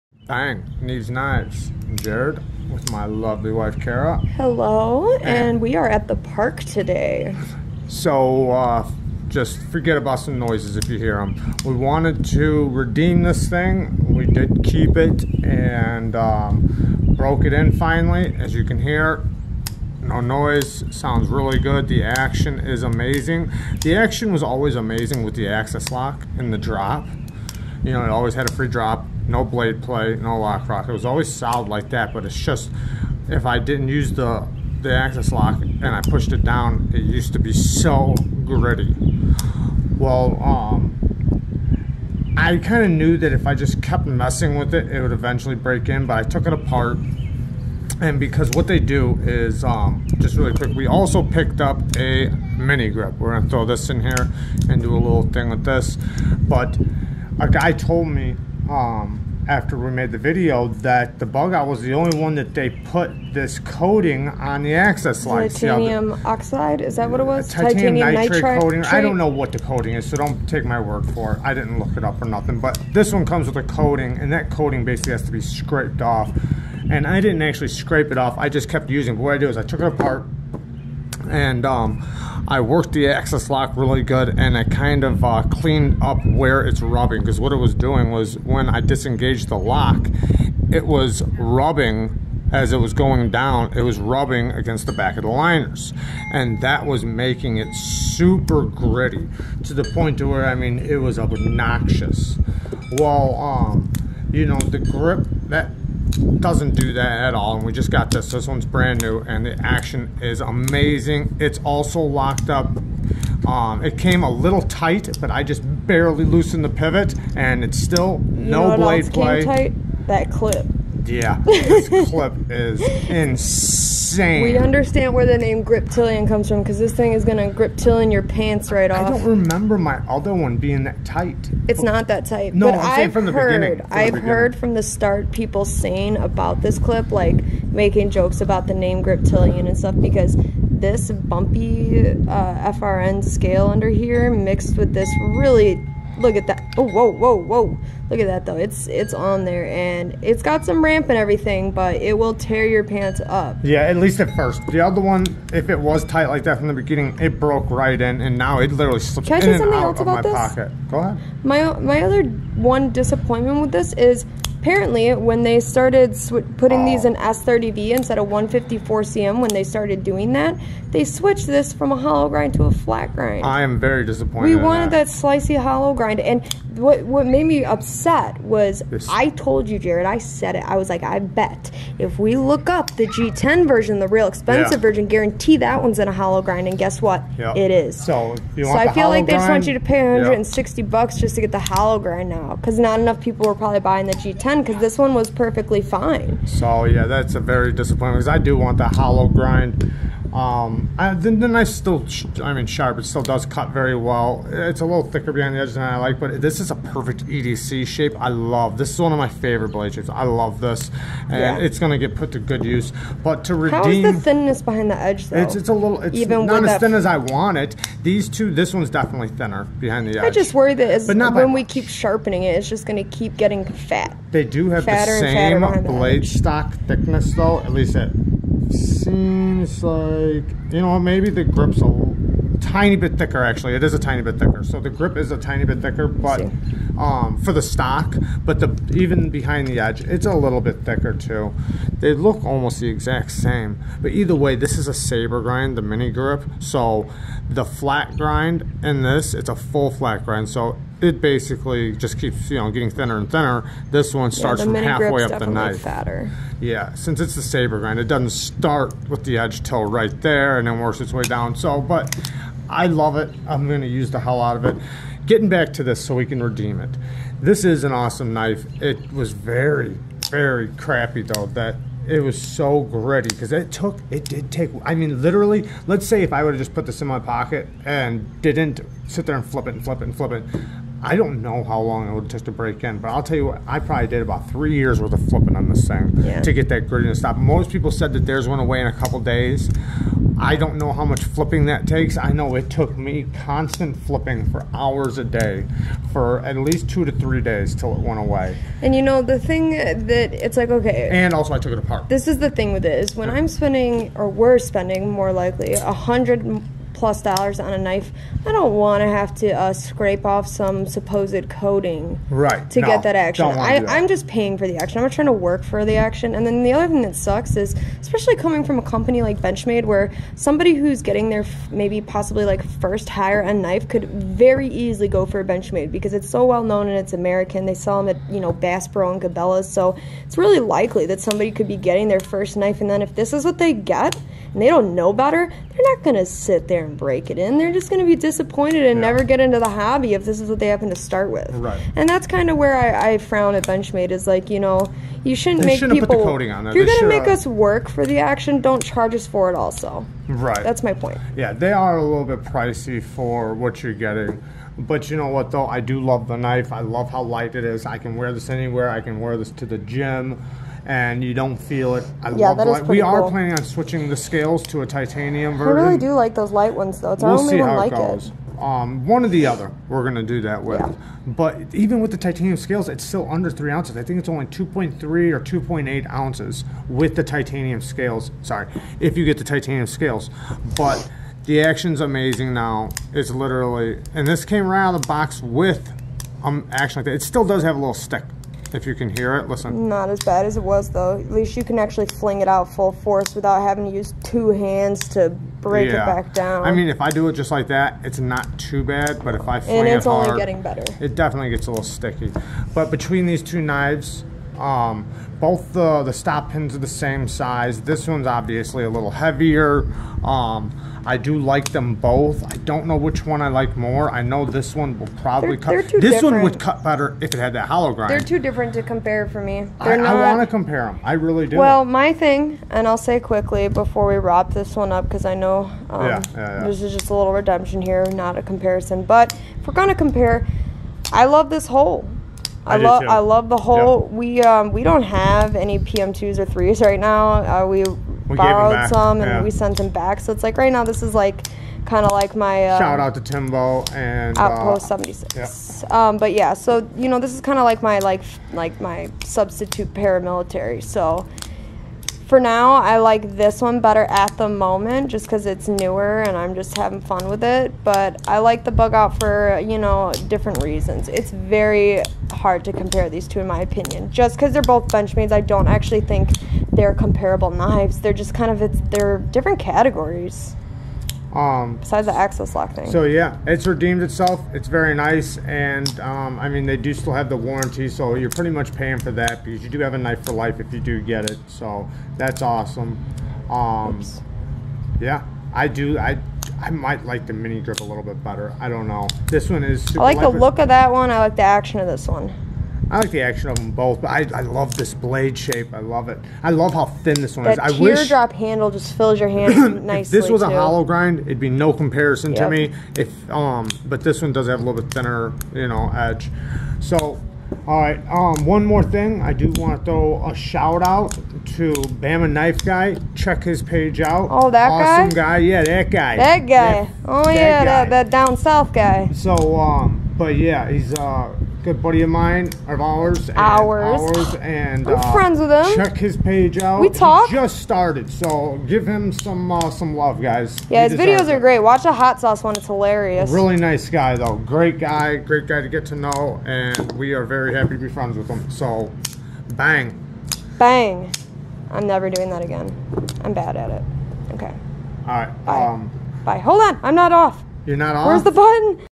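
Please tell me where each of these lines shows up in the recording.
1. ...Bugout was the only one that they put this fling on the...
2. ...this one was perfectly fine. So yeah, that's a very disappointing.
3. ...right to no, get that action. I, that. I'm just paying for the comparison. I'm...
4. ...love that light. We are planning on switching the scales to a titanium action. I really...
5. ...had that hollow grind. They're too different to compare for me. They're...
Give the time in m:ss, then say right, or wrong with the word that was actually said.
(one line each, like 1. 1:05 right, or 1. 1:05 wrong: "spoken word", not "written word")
1. 1:01 wrong: "coating", not "fling"
2. 3:14 right
3. 5:12 wrong: "action", not "comparison"
4. 6:02 wrong: "version", not "action"
5. 6:57 right.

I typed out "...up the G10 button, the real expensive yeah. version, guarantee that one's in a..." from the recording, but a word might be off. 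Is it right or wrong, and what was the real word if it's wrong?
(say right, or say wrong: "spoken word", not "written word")
wrong: "version", not "button".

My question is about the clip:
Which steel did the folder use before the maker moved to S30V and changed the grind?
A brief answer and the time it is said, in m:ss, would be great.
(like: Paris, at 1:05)
154cm, at 2:48.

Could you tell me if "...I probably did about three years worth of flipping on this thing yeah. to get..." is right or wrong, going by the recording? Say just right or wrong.
right.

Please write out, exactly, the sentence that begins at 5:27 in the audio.
They sell them at you know Bass Pro and Cabela's, so it's really likely that somebody could be getting their first knife.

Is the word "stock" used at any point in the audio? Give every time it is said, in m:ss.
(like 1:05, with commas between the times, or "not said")
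3:46, 3:57.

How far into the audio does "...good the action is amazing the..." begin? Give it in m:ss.
0:21.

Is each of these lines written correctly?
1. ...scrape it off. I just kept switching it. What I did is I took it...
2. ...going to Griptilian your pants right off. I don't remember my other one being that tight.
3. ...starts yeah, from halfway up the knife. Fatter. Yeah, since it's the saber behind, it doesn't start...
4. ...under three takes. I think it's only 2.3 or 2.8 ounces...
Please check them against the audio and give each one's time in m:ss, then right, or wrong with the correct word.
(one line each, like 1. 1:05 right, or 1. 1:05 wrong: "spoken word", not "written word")
1. 1:17 wrong: "using", not "switching"
2. 2:07 right
3. 4:14 wrong: "grind", not "behind"
4. 6:13 wrong: "ounces", not "takes".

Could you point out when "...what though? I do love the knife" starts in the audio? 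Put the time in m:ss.
5:55.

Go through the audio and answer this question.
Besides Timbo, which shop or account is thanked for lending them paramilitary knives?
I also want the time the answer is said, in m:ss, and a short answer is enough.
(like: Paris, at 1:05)
Outpost 76, at 7:24.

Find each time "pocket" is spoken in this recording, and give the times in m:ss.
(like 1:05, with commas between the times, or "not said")
2:40, 4:37.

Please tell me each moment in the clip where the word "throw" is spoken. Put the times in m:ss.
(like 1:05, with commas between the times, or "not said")
0:53, 8:29.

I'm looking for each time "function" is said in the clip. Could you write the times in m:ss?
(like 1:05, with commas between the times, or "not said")
not said.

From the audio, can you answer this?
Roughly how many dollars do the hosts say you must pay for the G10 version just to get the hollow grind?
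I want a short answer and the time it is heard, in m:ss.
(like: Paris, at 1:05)
160, at 3:10.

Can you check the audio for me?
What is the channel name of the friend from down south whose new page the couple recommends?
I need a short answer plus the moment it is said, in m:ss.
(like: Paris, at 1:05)
Bama Knife Guy, at 8:32.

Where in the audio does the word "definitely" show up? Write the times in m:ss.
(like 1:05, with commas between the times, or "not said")
3:38, 6:41.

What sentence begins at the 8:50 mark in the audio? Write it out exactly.
Yeah, he his videos are it.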